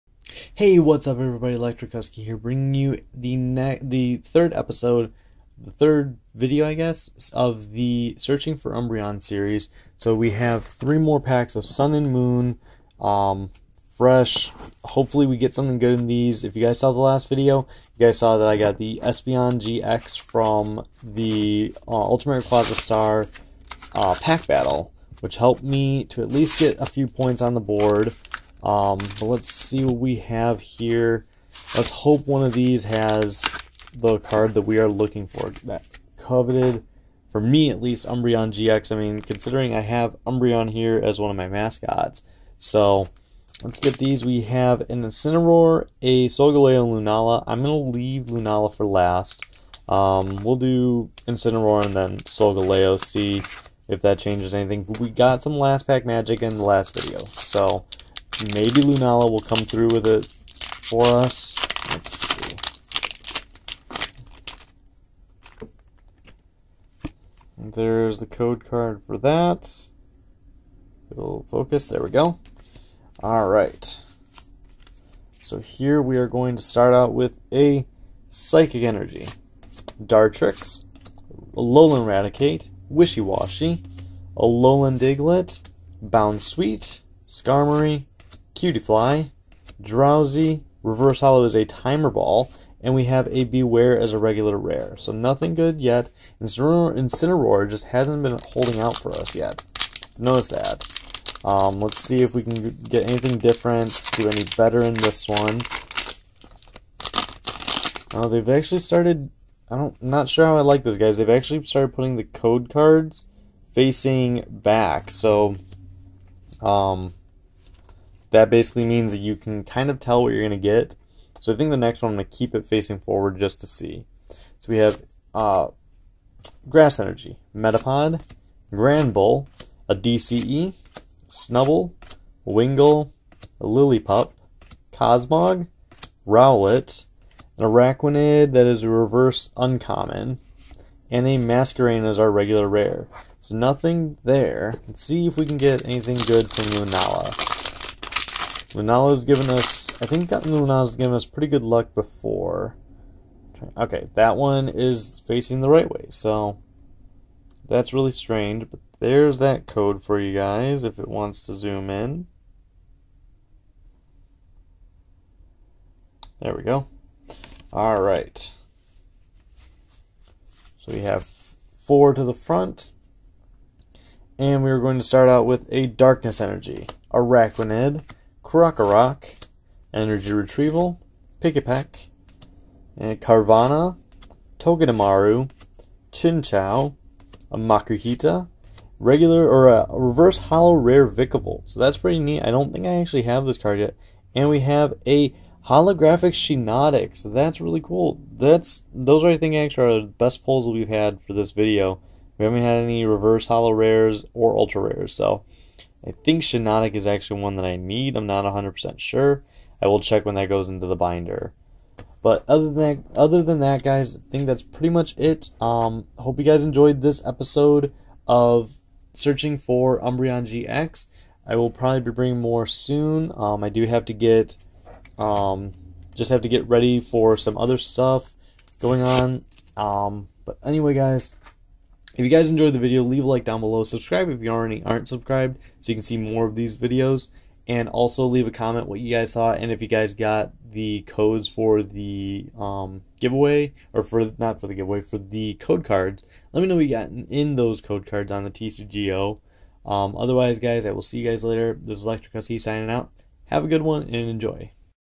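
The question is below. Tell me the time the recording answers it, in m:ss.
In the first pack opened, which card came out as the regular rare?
1:33.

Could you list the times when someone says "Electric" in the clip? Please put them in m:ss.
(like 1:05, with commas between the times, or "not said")
0:01, 4:12.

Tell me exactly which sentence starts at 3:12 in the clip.
I don't think I actually have this card yet.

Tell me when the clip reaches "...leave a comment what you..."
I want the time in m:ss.
3:58.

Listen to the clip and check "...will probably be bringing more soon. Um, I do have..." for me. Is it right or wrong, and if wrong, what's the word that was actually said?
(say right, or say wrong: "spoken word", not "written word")
right.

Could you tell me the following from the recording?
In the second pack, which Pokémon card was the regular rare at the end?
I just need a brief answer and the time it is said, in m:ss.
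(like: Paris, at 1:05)
Masquerain, at 2:21.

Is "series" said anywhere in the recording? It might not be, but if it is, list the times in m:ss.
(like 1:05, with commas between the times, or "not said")
0:09.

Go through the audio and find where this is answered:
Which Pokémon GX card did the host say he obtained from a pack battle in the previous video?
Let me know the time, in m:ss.
0:19.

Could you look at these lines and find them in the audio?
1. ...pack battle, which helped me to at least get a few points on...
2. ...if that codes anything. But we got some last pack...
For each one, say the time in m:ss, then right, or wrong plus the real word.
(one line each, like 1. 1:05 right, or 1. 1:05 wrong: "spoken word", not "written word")
1. 0:24 right
2. 0:53 wrong: "changes", not "codes".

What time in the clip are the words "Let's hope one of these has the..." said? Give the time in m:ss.
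0:31.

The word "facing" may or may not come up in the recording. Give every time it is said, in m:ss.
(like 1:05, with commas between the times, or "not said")
1:53, 2:02, 2:35.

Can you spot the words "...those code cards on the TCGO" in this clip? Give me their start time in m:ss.
4:07.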